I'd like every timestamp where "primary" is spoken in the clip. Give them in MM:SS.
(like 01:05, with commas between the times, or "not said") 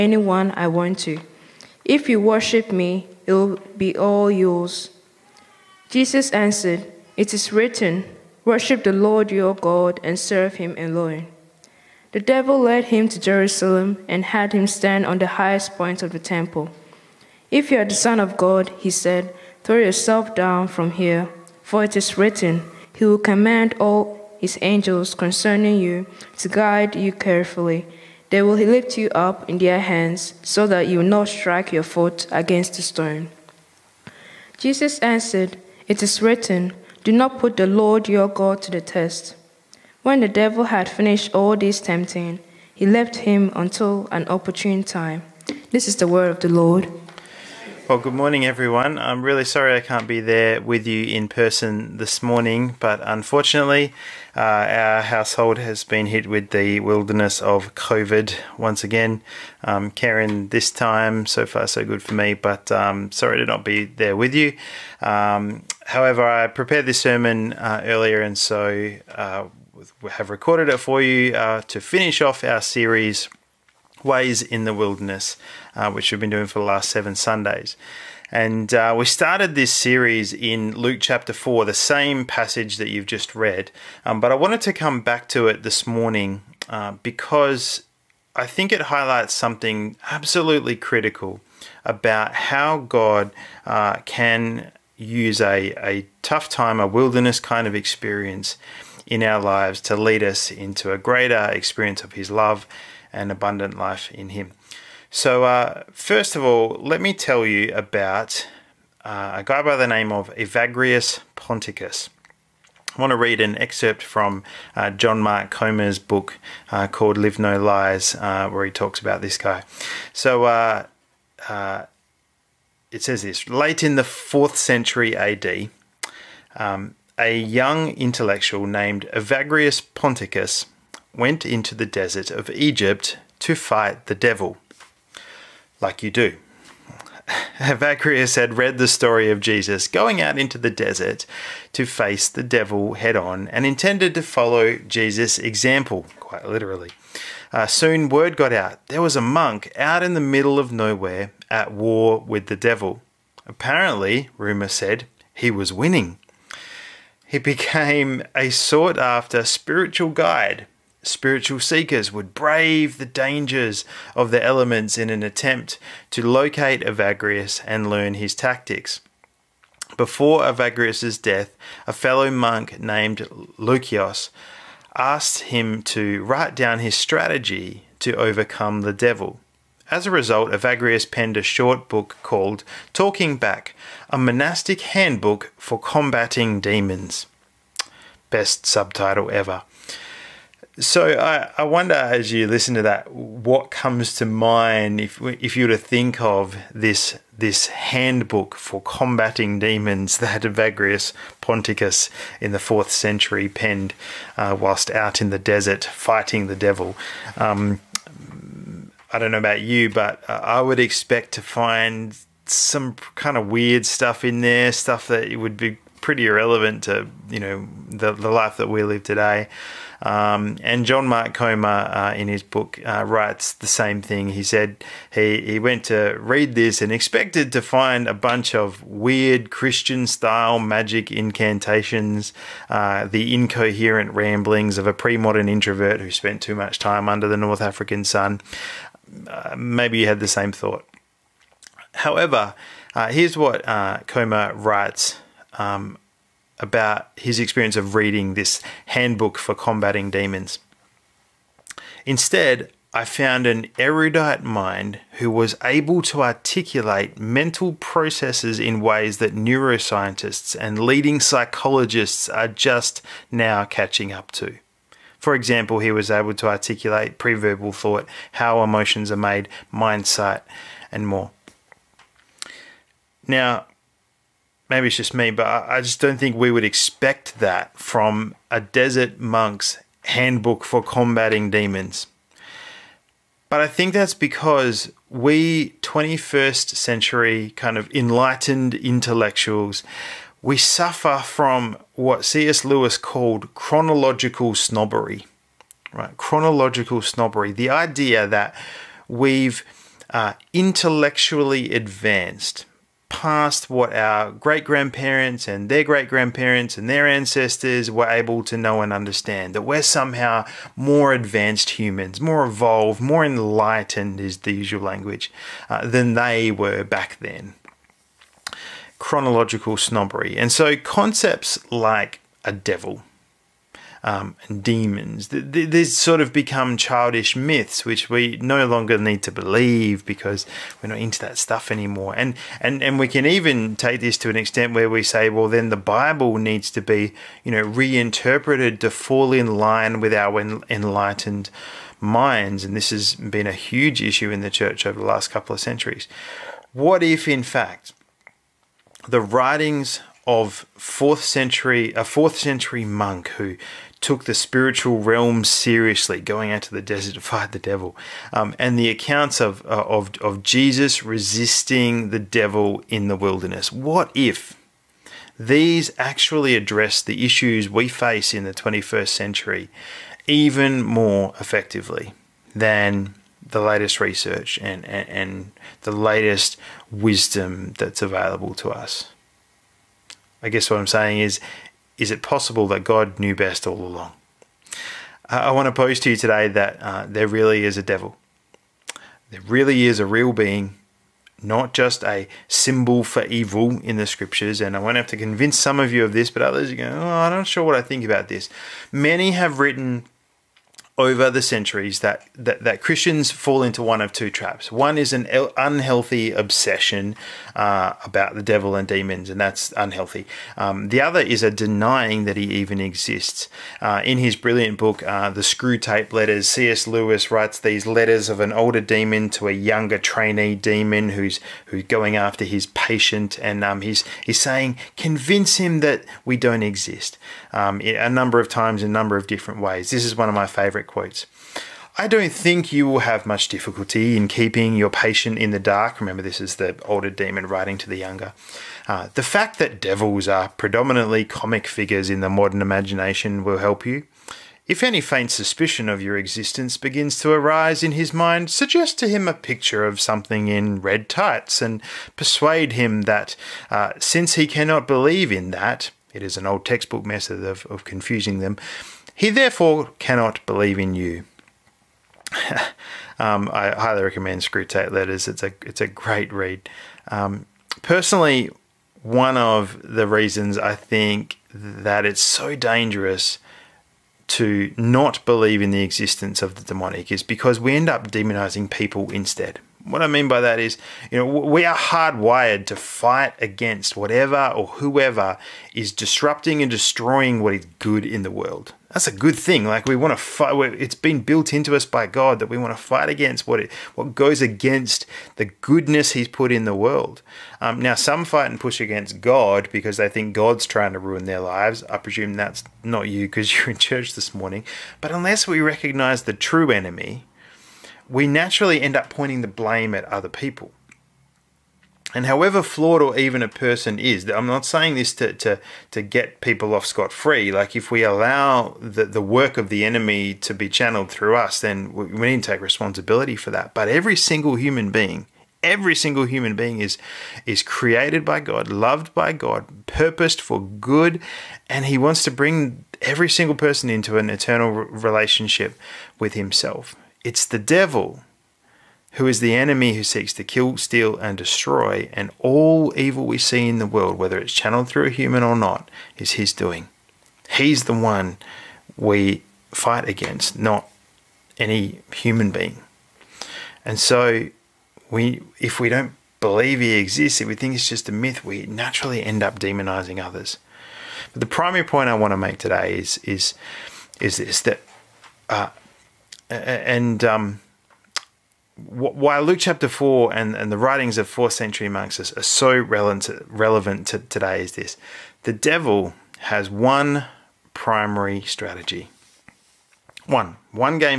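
09:21, 09:37.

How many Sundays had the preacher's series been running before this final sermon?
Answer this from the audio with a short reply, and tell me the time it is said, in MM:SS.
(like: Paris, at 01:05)
7, at 01:16.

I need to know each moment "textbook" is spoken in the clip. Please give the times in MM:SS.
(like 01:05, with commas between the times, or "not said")
07:36.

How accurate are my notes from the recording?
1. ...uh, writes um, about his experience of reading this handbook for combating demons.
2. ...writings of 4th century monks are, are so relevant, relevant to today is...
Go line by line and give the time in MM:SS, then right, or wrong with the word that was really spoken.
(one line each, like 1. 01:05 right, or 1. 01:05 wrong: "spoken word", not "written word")
1. 04:03 right
2. 09:30 right.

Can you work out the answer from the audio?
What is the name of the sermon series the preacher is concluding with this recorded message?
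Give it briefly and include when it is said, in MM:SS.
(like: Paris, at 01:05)
Ways in the Wilderness, at 01:14.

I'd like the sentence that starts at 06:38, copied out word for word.
Many have written over the centuries that, that, that Christians fall into one of two traps.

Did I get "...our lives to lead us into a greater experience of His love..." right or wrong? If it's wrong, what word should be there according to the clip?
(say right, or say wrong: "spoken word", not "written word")
right.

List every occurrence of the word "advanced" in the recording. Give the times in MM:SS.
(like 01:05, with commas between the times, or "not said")
05:01, 05:11.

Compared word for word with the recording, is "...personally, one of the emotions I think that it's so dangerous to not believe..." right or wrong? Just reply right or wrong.
wrong.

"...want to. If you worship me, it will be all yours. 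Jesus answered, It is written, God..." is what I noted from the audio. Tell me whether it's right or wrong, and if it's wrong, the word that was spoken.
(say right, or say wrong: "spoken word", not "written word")
wrong: "Worship", not "God".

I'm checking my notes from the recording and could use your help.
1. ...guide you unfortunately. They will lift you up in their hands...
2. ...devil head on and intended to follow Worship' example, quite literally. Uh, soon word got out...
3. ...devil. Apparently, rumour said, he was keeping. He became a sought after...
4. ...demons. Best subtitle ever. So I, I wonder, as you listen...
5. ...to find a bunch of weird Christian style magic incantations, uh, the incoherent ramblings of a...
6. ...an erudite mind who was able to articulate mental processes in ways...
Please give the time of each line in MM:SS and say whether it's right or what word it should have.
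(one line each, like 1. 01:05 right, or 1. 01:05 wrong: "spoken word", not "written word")
1. 00:26 wrong: "carefully", not "unfortunately"
2. 02:22 wrong: "Jesus", not "Worship"
3. 02:32 wrong: "winning", not "keeping"
4. 03:06 right
5. 03:47 right
6. 04:13 right.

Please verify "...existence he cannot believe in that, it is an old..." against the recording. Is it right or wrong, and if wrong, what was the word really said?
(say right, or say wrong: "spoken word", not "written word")
wrong: "since", not "existence".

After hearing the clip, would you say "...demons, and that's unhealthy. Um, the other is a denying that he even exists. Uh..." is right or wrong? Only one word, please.
right.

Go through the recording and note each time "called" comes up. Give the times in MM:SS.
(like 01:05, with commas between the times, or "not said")
01:56, 03:02, 04:52.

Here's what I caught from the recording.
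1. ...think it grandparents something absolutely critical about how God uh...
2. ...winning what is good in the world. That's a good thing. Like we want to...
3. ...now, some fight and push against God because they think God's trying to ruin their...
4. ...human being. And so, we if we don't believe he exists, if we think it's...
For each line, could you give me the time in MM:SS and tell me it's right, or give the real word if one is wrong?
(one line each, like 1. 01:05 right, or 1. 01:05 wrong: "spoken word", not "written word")
1. 01:28 wrong: "highlights", not "grandparents"
2. 08:06 wrong: "destroying", not "winning"
3. 08:17 right
4. 09:12 right.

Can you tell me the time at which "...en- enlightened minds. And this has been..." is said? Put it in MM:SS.
05:40.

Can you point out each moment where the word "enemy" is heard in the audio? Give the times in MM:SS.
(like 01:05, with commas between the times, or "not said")
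08:26, 08:39, 08:59.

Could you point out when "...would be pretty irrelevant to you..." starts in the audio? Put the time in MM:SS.
03:35.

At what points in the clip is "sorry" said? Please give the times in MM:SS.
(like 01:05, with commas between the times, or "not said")
00:49, 01:03.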